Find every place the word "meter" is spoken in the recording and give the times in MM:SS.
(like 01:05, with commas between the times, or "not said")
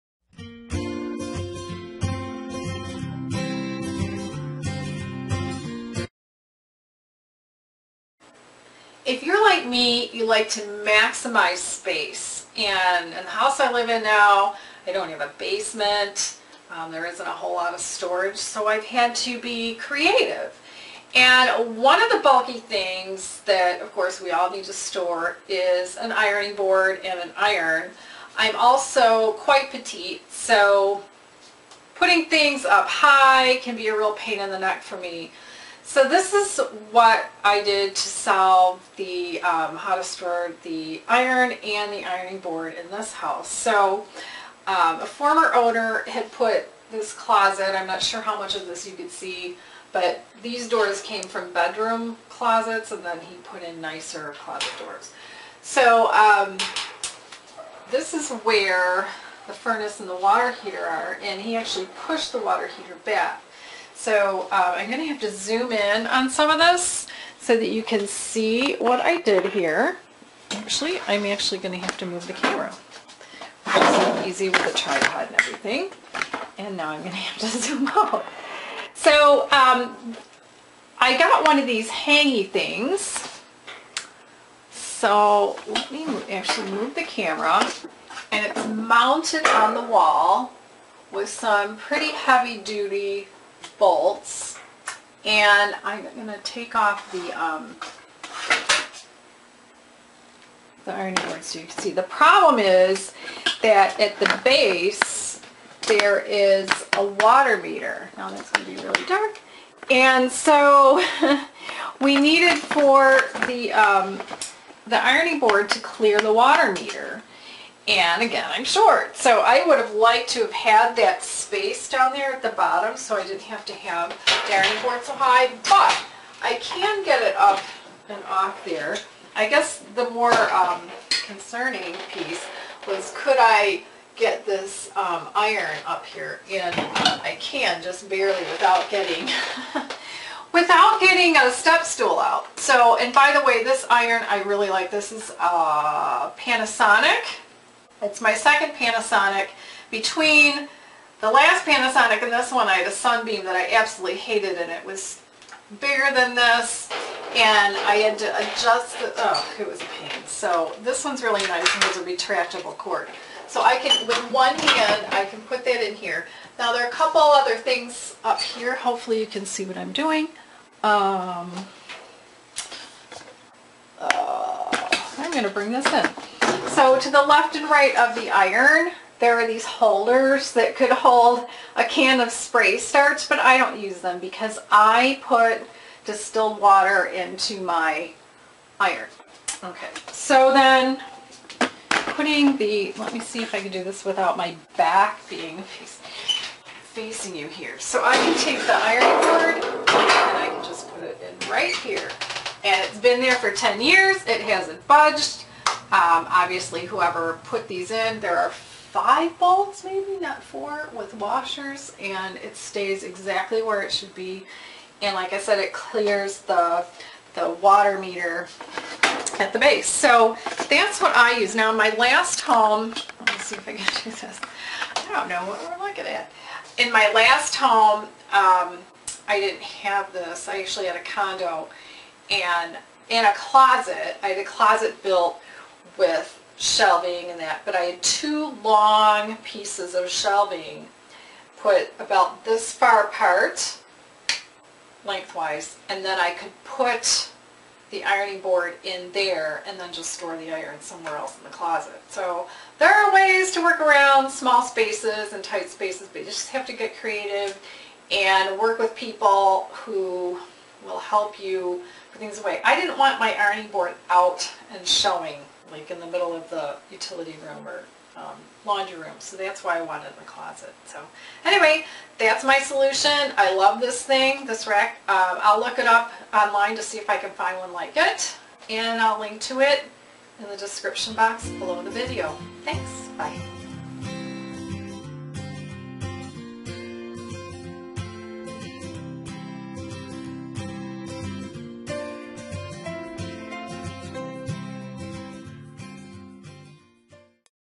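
01:47, 01:56, 03:37.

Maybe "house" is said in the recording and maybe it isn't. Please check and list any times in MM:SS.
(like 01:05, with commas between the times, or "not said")
00:13, 00:43.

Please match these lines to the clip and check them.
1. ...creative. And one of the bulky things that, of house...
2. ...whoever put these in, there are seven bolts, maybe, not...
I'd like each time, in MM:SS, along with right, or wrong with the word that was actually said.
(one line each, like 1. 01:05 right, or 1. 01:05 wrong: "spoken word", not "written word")
1. 00:19 wrong: "course", not "house"
2. 03:26 wrong: "five", not "seven".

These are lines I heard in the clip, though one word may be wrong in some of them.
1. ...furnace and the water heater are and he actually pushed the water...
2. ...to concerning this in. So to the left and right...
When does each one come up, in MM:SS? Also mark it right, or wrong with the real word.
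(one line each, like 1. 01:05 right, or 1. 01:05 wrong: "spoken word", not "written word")
1. 00:59 right
2. 02:55 wrong: "bring", not "concerning".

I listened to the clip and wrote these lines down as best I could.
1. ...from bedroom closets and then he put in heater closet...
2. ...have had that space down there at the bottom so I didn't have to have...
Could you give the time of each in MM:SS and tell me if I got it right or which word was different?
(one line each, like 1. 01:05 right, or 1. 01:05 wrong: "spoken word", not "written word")
1. 00:51 wrong: "nicer", not "heater"
2. 02:00 right.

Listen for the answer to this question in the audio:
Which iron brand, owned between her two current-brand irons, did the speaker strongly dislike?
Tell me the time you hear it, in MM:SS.
02:32.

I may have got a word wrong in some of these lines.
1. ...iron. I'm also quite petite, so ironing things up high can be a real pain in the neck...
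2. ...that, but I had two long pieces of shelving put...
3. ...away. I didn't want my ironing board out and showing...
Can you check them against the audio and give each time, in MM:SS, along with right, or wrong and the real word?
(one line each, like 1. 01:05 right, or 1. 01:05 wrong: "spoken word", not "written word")
1. 00:27 wrong: "putting", not "ironing"
2. 03:57 right
3. 04:22 right.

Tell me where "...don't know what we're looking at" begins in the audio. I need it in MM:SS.
03:45.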